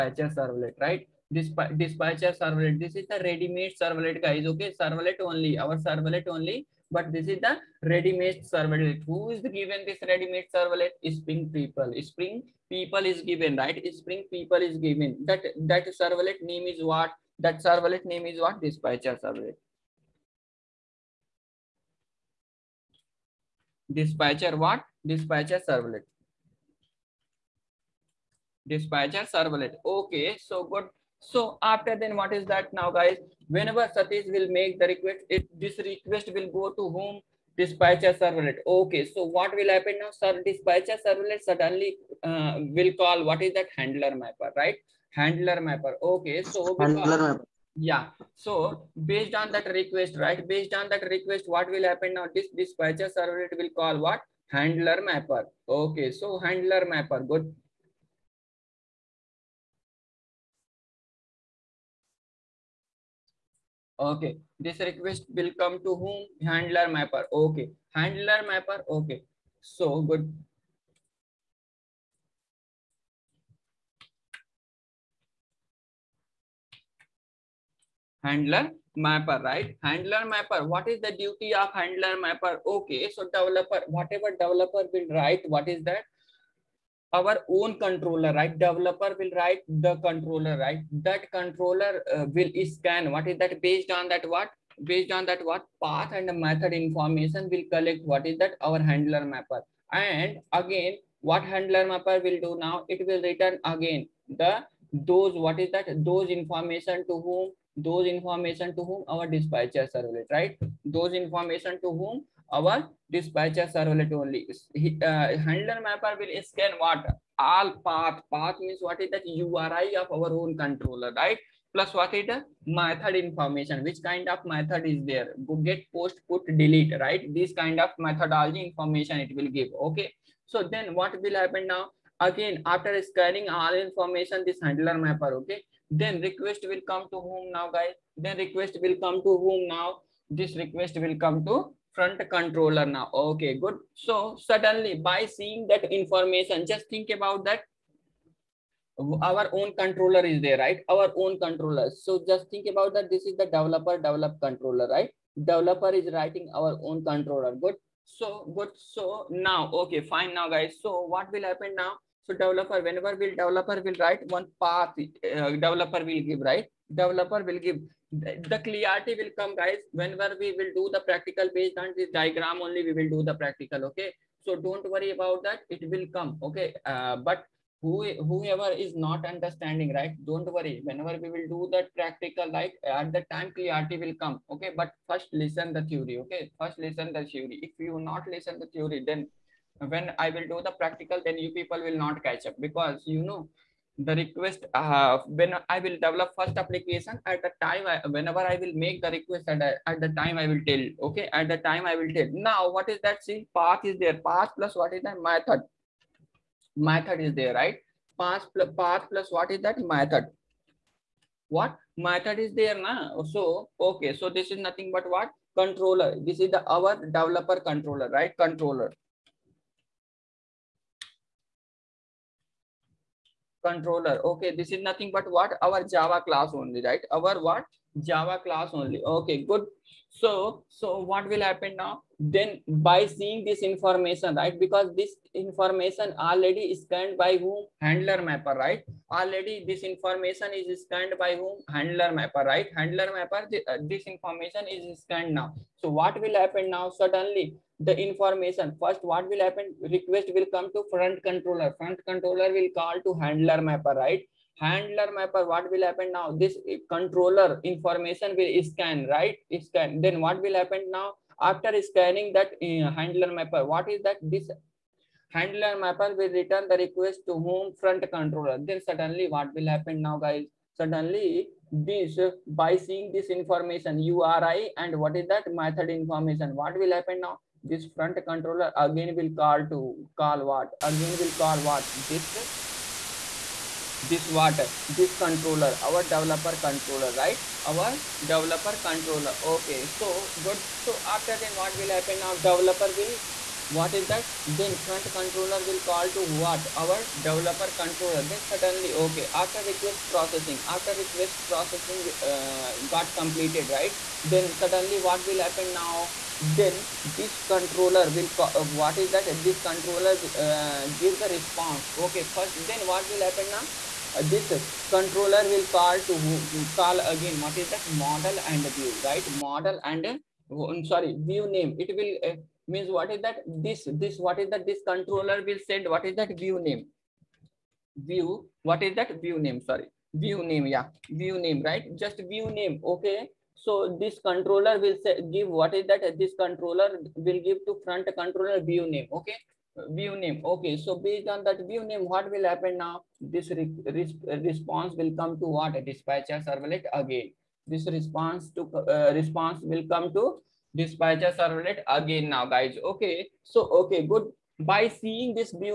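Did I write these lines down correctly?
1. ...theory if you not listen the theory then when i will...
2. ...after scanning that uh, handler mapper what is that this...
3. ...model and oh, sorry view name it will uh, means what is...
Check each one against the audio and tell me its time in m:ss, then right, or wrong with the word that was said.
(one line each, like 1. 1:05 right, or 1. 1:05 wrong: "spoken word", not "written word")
1. 3:07 right
2. 4:21 right
3. 5:19 right.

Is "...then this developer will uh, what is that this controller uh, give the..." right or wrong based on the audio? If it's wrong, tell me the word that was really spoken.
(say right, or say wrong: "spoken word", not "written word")
wrong: "controller", not "developer".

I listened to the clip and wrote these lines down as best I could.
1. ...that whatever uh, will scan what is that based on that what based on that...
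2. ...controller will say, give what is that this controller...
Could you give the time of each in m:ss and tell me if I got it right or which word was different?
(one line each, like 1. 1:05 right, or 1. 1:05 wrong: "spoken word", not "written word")
1. 1:31 wrong: "controller", not "whatever"
2. 5:34 right.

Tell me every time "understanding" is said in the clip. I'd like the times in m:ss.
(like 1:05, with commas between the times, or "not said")
2:59.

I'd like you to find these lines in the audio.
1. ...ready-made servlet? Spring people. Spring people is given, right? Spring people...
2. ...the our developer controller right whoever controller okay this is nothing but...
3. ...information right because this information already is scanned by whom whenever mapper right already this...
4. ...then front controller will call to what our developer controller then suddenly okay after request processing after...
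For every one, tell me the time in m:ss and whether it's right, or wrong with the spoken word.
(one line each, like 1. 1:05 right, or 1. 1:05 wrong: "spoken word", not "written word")
1. 0:10 right
2. 3:36 wrong: "controller", not "whoever"
3. 3:53 wrong: "handler", not "whenever"
4. 4:54 right.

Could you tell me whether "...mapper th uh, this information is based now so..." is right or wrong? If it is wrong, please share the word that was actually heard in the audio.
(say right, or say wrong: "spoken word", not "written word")
wrong: "scanned", not "based".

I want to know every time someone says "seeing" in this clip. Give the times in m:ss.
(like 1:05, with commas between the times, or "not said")
2:25, 3:53, 4:32, 5:54.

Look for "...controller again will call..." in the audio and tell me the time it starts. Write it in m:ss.
4:38.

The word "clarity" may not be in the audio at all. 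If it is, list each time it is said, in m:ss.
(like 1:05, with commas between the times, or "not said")
2:48, 3:03.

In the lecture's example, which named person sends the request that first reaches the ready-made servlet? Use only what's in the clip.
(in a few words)
Satish.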